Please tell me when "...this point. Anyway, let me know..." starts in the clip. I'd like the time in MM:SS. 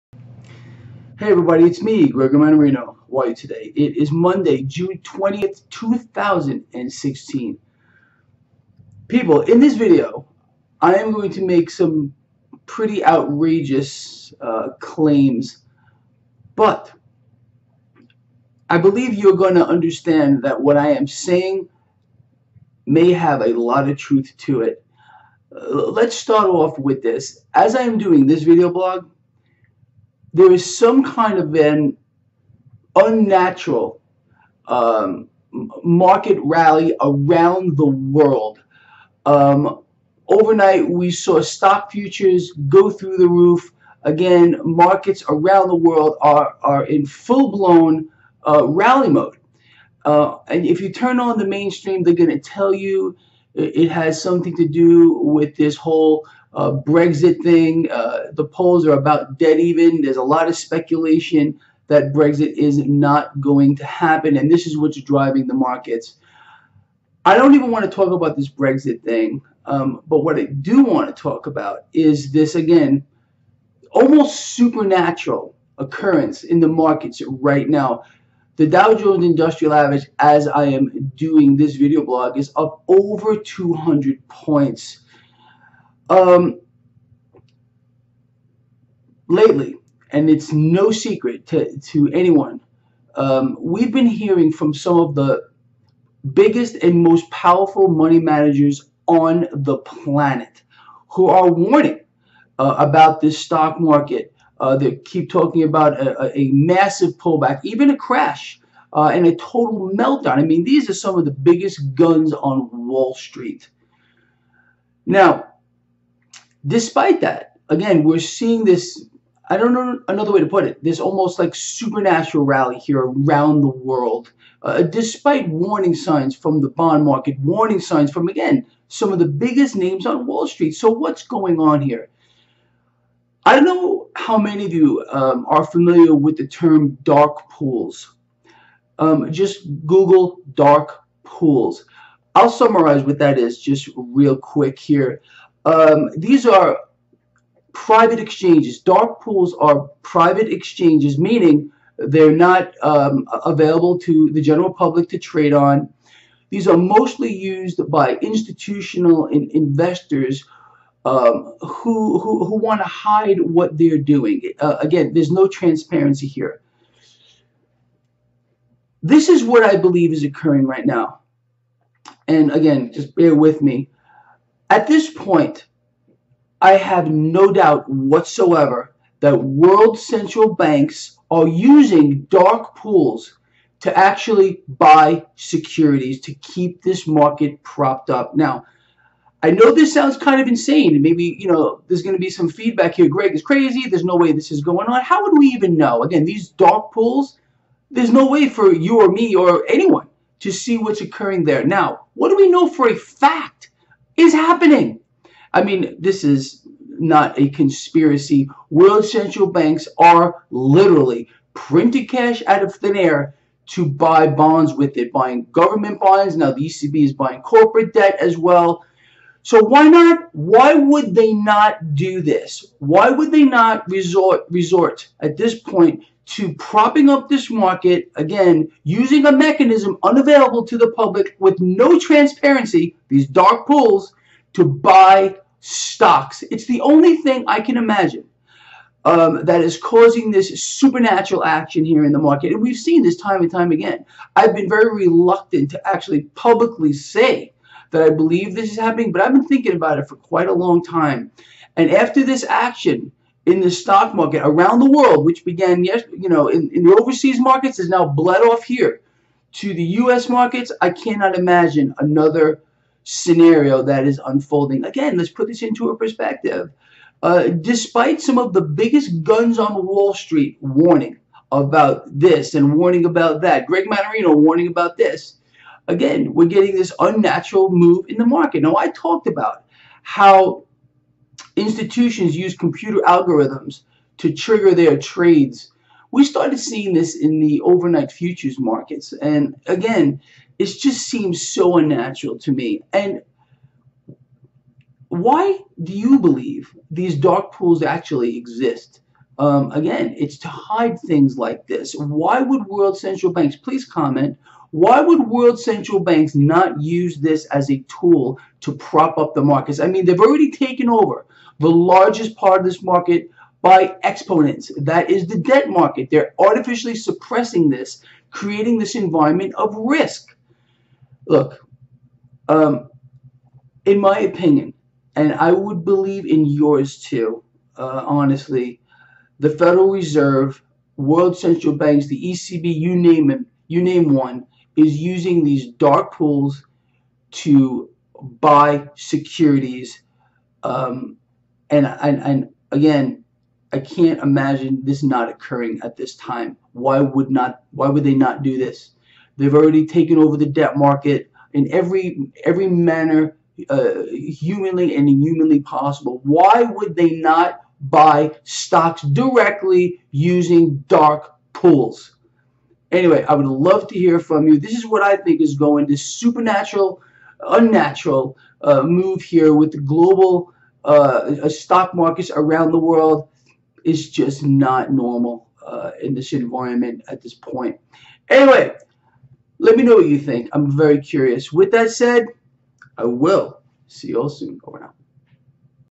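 06:17.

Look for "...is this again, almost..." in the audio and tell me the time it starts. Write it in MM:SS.
01:11.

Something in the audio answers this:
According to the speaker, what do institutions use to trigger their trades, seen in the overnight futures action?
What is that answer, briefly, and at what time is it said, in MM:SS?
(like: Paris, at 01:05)
Computer algorithms, at 04:42.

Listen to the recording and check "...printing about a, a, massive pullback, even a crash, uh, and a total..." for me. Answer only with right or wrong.
wrong.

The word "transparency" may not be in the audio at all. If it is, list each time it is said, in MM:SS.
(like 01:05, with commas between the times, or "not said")
02:45, 03:51.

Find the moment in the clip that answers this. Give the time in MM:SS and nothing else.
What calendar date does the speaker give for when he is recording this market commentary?
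00:04.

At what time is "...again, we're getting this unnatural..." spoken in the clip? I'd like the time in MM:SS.
04:35.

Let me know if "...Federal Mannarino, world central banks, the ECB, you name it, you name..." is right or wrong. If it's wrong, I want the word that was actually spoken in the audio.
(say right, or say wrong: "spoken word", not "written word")
wrong: "Reserve", not "Mannarino".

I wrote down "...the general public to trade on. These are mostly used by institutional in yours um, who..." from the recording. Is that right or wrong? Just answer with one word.
wrong.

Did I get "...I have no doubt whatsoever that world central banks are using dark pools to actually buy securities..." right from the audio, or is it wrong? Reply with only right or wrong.
right.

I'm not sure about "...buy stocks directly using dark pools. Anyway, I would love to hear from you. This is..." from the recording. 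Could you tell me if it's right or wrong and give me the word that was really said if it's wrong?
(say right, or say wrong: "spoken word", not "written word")
right.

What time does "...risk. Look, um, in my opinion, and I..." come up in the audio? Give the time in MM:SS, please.
05:19.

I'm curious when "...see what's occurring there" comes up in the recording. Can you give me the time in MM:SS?
03:20.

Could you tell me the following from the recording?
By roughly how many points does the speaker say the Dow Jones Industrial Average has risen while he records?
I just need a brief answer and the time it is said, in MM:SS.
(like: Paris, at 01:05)
200, at 01:23.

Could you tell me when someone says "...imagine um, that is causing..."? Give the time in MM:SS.
03:57.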